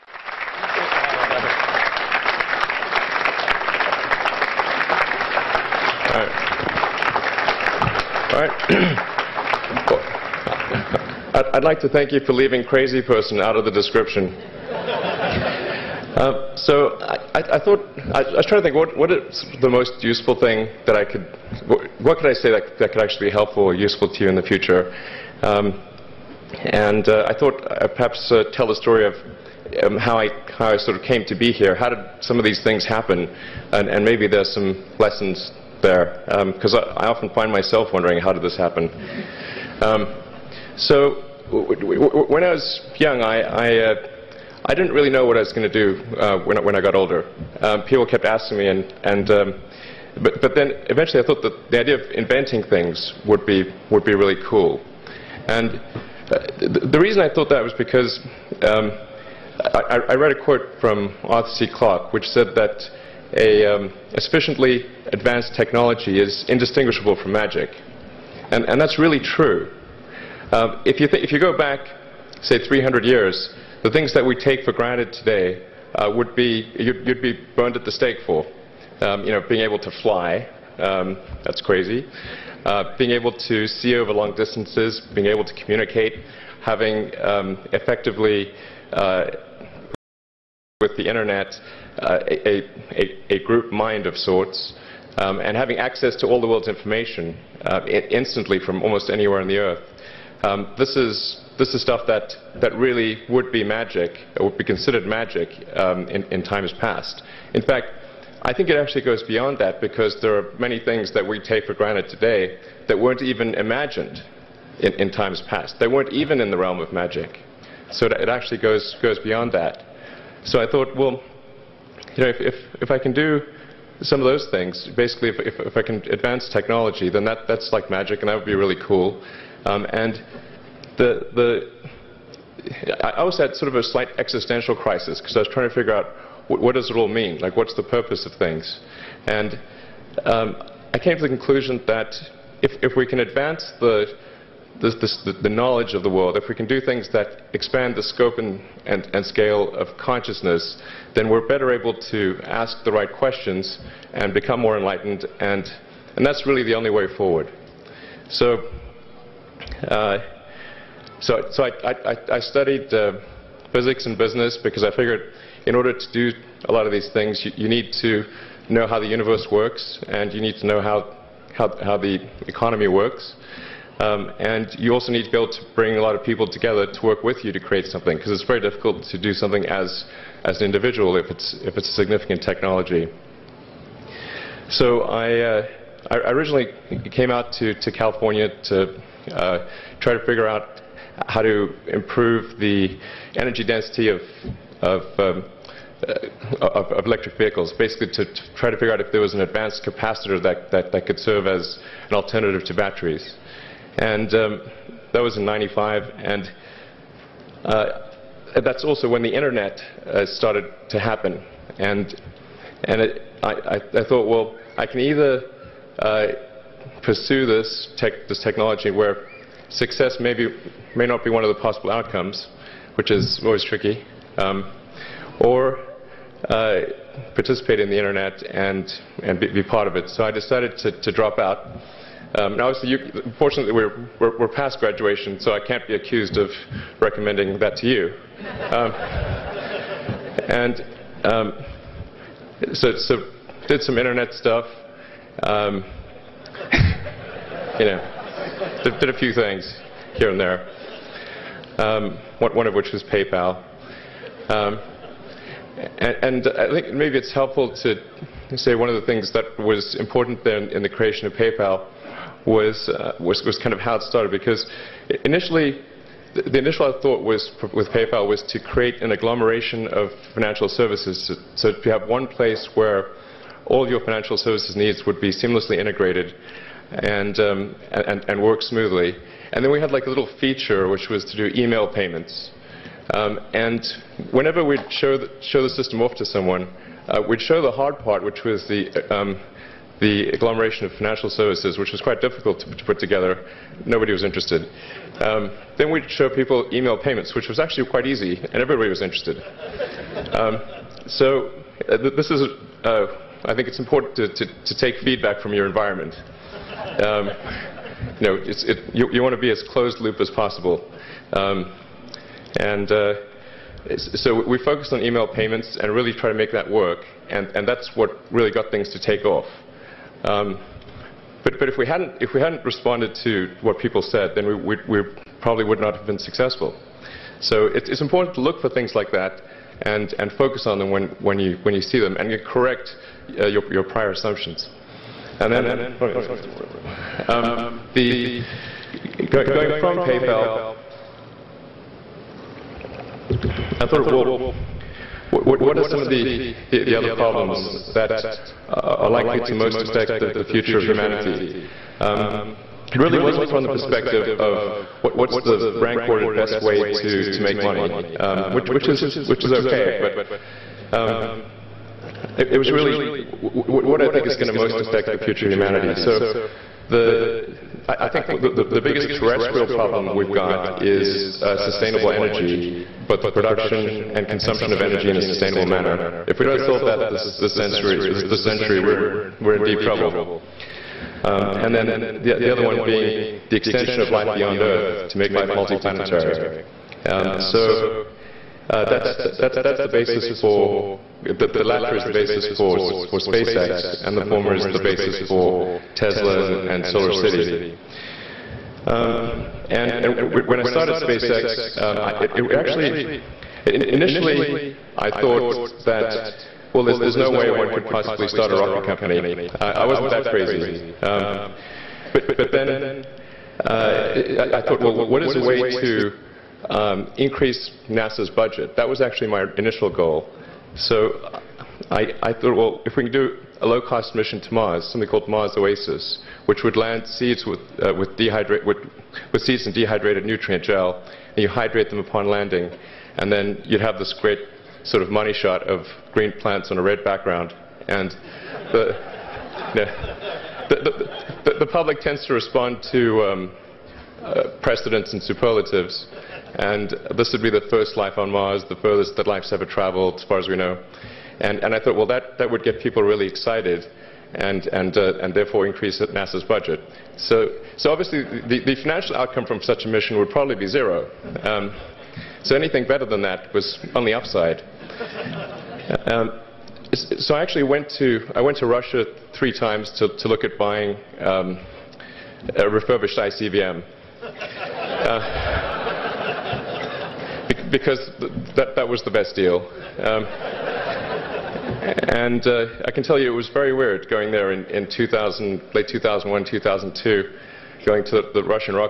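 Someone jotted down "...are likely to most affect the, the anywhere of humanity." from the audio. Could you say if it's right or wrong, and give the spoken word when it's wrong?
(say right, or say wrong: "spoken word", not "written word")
wrong: "future", not "anywhere".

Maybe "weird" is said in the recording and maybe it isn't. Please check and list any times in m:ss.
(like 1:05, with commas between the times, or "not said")
8:03.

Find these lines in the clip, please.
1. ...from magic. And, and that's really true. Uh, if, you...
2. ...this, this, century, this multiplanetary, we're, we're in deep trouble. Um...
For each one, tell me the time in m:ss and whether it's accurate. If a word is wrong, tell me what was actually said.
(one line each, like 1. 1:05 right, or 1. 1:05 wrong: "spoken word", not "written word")
1. 1:07 right
2. 6:17 wrong: "century", not "multiplanetary".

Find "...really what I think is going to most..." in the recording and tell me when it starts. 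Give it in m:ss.
6:02.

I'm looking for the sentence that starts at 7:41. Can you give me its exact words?
Um, so anything better than that was on the upside.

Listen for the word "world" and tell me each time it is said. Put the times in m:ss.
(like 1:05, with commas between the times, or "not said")
1:36, 2:26.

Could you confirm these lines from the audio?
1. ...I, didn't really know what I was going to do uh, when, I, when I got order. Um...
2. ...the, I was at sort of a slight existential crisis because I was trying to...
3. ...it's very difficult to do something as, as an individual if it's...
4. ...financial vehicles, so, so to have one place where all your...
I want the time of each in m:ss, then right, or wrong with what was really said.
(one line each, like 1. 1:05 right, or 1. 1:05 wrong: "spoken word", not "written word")
1. 0:44 wrong: "older", not "order"
2. 2:11 right
3. 2:58 right
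4. 4:30 wrong: "services", not "vehicles".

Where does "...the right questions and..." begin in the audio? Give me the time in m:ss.
2:32.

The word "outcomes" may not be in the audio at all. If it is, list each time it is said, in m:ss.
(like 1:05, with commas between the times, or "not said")
3:41, 7:39.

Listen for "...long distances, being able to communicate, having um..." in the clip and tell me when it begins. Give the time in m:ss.
1:24.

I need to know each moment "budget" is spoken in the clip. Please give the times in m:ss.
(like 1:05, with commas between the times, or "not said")
6:58, 7:36.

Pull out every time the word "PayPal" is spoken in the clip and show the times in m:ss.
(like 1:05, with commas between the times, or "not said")
4:13, 4:21, 4:27, 5:39.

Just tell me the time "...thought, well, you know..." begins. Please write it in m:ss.
2:00.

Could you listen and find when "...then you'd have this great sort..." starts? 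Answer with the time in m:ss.
7:13.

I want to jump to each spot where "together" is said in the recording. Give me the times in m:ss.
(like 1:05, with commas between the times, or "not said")
2:56, 4:52.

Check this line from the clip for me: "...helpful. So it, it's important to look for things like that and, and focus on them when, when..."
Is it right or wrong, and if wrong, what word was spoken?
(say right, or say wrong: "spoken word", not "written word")
wrong: "successful", not "helpful".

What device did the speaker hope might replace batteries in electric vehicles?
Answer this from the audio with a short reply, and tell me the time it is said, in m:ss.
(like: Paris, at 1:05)
advanced capacitor, at 3:19.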